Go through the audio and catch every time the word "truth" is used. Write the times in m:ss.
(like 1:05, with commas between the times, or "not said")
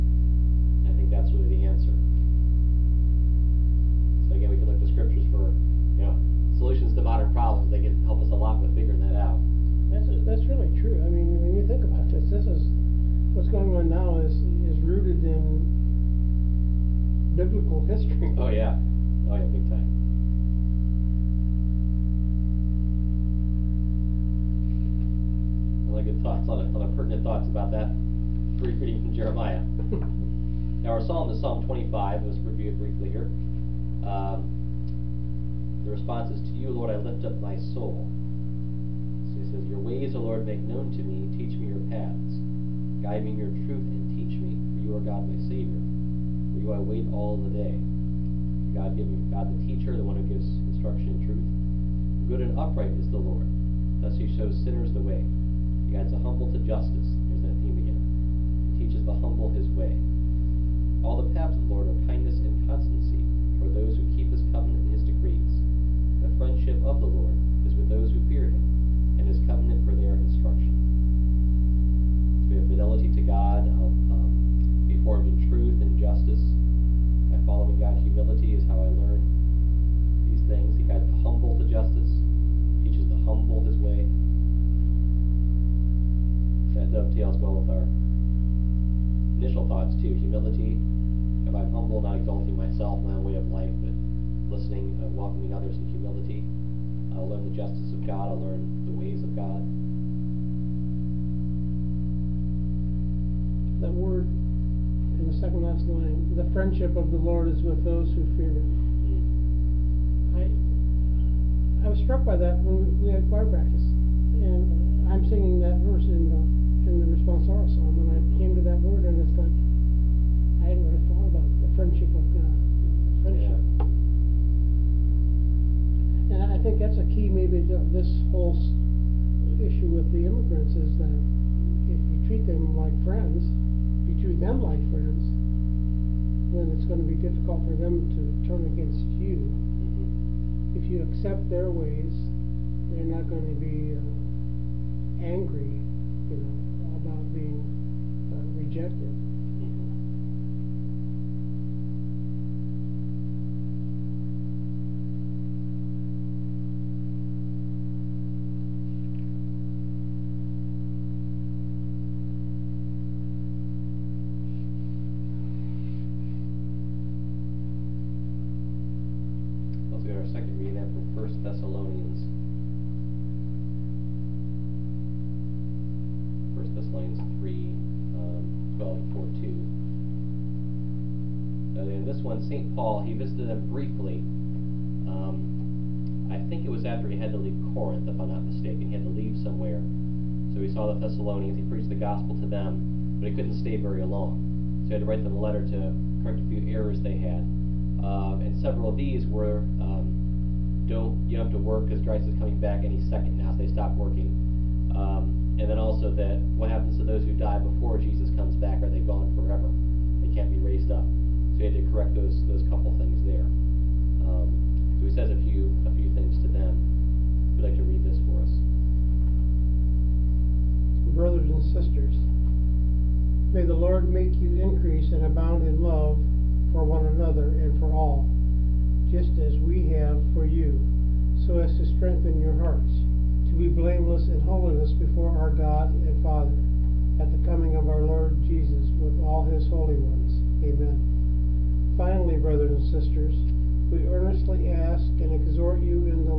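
0:43, 0:51, 1:15.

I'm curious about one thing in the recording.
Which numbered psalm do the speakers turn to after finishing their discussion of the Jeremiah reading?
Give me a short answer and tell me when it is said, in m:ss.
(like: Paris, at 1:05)
Psalm 25, at 0:31.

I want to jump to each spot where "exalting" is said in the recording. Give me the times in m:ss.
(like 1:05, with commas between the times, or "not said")
1:32.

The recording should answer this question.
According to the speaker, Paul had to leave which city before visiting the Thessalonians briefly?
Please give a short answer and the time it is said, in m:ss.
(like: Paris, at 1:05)
Corinth, at 3:07.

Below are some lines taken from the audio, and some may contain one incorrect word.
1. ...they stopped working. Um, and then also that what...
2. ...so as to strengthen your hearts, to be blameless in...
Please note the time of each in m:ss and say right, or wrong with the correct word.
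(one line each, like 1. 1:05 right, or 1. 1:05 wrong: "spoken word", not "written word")
1. 3:23 right
2. 3:51 right.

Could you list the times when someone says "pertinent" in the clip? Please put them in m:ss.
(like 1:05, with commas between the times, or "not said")
0:26.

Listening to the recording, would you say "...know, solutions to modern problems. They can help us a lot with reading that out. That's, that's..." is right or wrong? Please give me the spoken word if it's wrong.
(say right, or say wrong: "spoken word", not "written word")
wrong: "figuring", not "reading".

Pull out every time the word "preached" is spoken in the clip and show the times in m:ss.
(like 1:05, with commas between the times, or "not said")
3:11.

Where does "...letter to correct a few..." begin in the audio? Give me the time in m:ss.
3:15.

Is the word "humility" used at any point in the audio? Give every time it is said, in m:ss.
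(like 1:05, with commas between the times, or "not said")
1:18, 1:30, 1:35.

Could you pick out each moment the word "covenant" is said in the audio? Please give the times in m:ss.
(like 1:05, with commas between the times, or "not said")
1:04, 1:09.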